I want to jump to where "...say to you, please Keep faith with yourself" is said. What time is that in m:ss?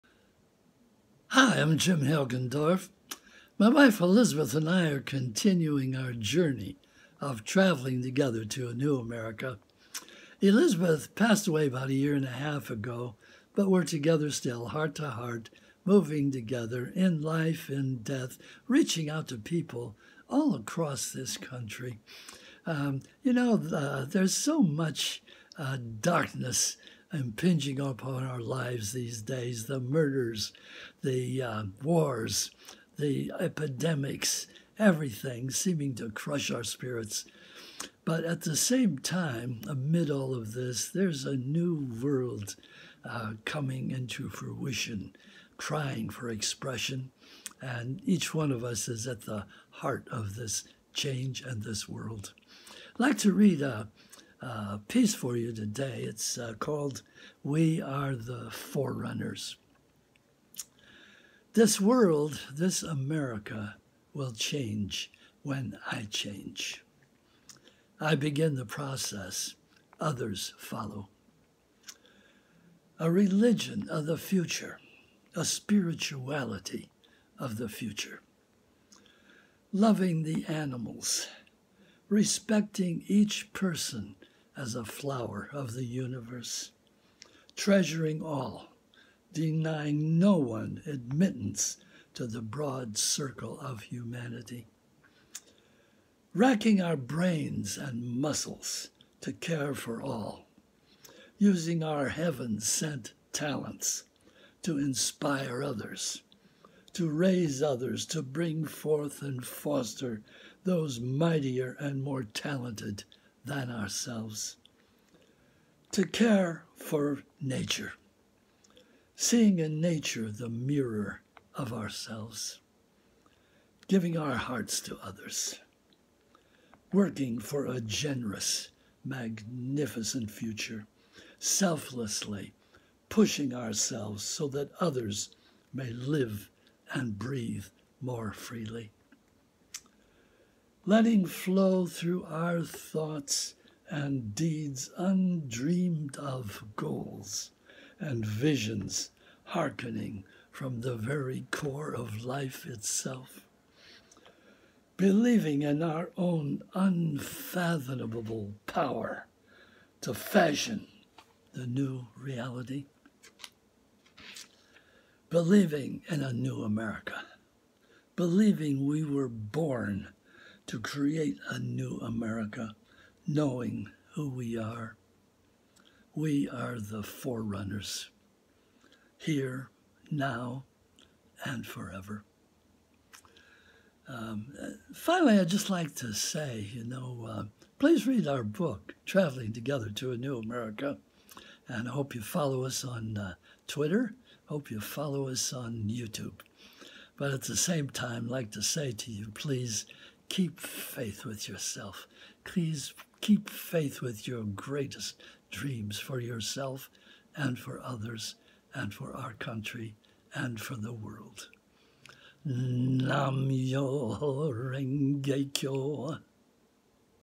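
3:18.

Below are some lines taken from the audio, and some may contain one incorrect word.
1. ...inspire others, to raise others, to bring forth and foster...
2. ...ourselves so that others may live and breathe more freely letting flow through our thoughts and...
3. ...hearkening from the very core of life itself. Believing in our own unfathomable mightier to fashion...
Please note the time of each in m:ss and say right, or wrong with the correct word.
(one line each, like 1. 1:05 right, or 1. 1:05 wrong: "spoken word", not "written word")
1. 1:44 right
2. 2:13 right
3. 2:29 wrong: "power", not "mightier".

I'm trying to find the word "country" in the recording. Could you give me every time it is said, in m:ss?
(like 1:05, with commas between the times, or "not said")
0:21, 3:29.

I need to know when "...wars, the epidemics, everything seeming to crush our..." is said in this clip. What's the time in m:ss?
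0:31.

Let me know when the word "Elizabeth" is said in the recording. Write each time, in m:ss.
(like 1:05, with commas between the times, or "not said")
0:04, 0:10.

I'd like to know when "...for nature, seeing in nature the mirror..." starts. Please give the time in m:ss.
1:56.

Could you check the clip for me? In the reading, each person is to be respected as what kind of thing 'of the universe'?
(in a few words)
A flower.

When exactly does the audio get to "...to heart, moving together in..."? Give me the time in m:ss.
0:14.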